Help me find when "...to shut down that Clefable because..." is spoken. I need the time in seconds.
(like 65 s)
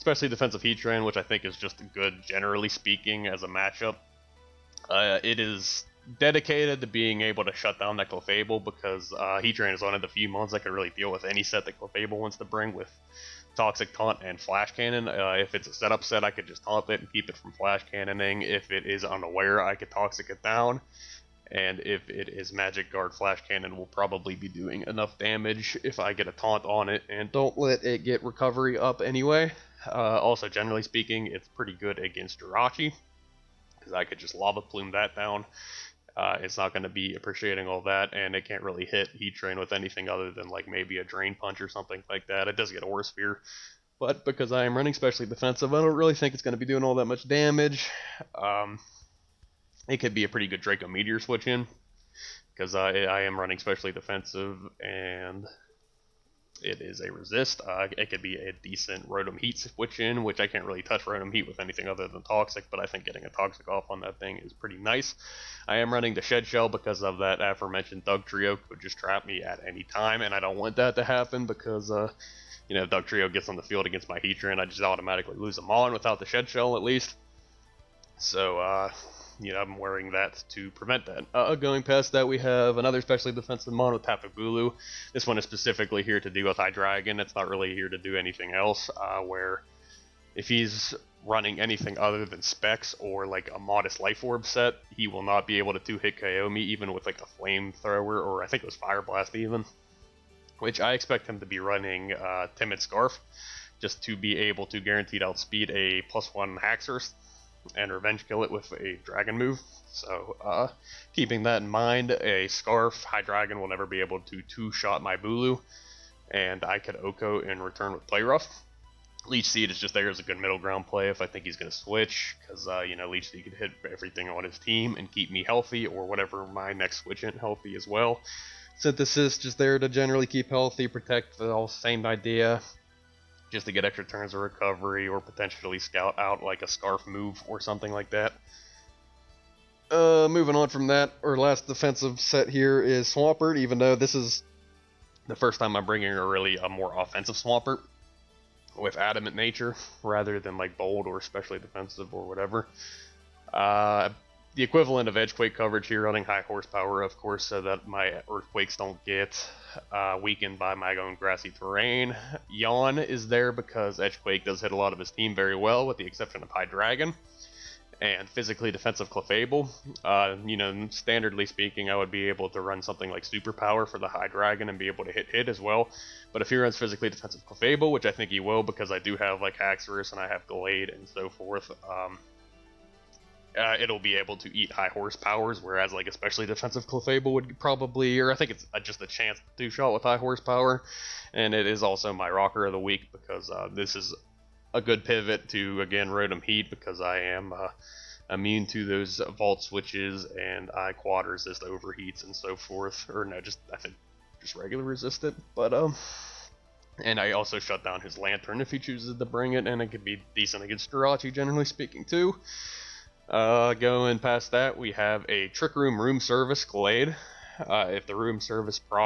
7 s.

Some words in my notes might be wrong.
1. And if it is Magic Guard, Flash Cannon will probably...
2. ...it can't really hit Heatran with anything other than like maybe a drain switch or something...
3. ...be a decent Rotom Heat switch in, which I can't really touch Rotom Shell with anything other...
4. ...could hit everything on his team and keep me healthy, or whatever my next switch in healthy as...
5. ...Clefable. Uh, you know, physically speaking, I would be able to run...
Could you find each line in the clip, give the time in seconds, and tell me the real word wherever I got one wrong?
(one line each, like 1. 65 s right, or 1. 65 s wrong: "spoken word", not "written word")
1. 21 s right
2. 38 s wrong: "punch", not "switch"
3. 58 s wrong: "Heat", not "Shell"
4. 123 s right
5. 169 s wrong: "standardly", not "physically".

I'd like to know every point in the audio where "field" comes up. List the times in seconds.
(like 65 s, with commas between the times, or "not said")
73 s.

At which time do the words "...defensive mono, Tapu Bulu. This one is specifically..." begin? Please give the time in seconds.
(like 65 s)
83 s.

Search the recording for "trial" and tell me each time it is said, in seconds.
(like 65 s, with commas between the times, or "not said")
not said.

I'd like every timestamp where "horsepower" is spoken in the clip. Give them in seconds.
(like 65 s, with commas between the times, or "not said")
156 s, 184 s, 190 s.